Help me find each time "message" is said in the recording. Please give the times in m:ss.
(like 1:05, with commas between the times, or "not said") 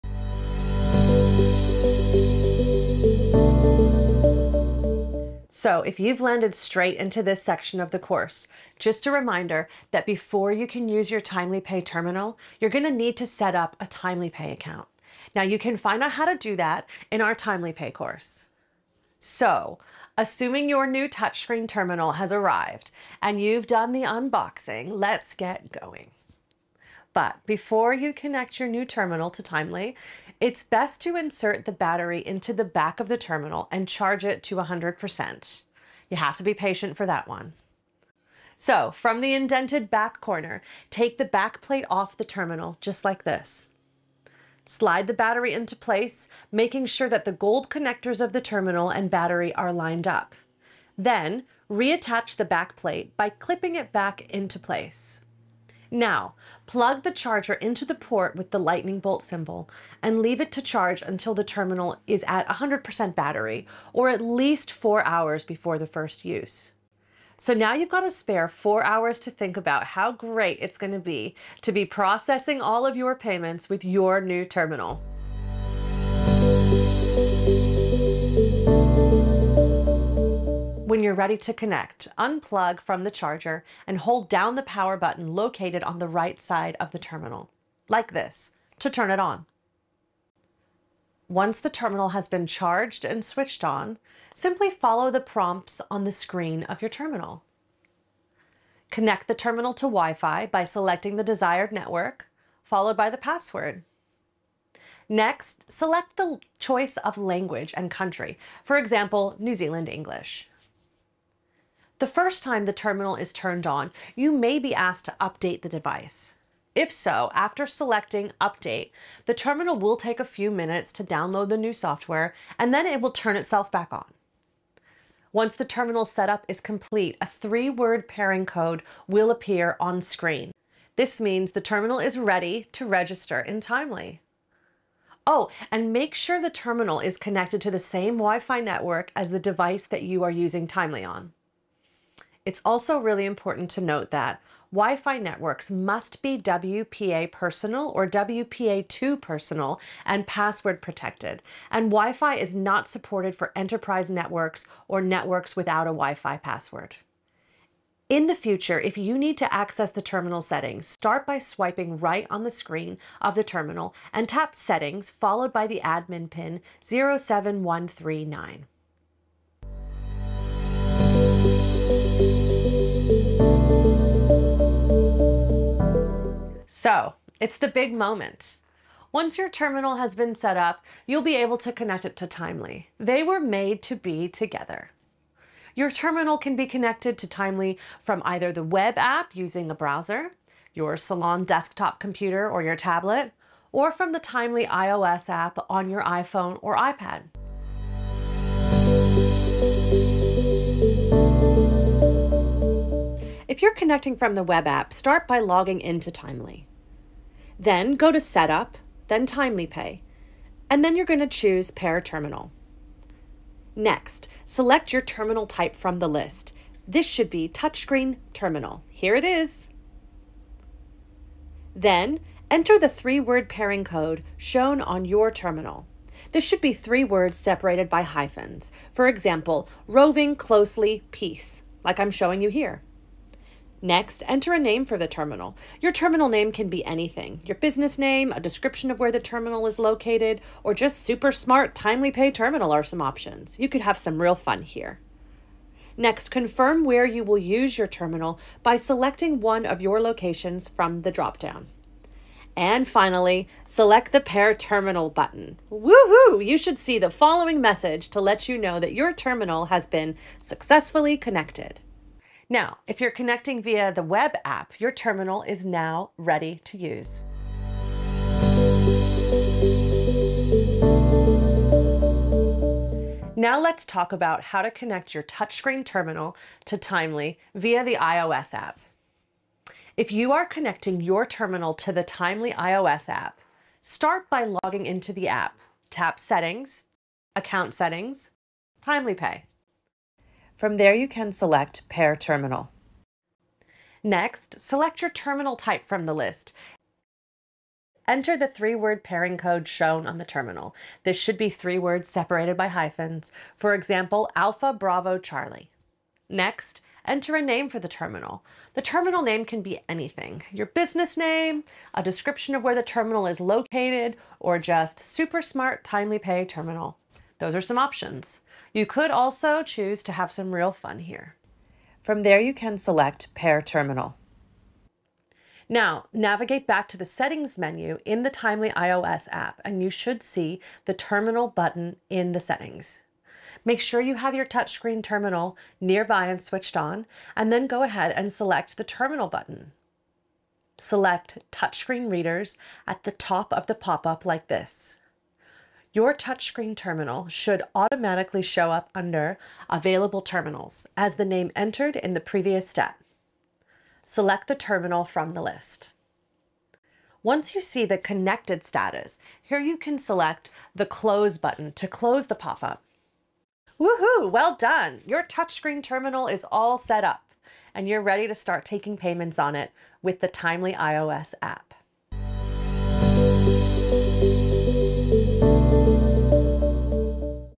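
4:17.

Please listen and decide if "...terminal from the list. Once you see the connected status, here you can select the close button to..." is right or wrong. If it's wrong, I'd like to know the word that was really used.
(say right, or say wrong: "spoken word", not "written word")
right.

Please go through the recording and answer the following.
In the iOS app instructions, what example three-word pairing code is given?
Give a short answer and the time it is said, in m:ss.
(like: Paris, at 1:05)
Alpha Bravo Charlie, at 5:04.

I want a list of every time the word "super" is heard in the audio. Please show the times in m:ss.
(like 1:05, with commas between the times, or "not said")
4:01, 5:14.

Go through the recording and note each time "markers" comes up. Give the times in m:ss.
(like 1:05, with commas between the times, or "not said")
not said.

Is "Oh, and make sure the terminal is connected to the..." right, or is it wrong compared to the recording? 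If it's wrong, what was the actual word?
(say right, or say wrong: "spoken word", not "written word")
right.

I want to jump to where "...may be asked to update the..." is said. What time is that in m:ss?
1:54.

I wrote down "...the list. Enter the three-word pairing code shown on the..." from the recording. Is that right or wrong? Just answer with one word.
right.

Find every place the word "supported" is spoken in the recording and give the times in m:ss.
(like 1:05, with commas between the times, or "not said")
2:32.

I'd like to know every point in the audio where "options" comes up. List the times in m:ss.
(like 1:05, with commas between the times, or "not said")
4:03, 5:17.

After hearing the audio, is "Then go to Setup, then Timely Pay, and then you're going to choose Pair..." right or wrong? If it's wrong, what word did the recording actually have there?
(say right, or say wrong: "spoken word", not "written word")
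right.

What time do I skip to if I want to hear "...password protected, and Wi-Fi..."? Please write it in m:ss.
2:30.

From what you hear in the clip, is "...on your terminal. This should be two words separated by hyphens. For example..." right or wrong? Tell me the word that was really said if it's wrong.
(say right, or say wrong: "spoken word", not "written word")
wrong: "three", not "two".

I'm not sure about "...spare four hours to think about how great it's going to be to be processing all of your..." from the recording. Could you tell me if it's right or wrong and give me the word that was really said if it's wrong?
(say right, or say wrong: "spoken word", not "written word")
right.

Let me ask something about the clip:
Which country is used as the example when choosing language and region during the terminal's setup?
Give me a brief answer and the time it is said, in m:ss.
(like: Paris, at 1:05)
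New Zealand, at 1:49.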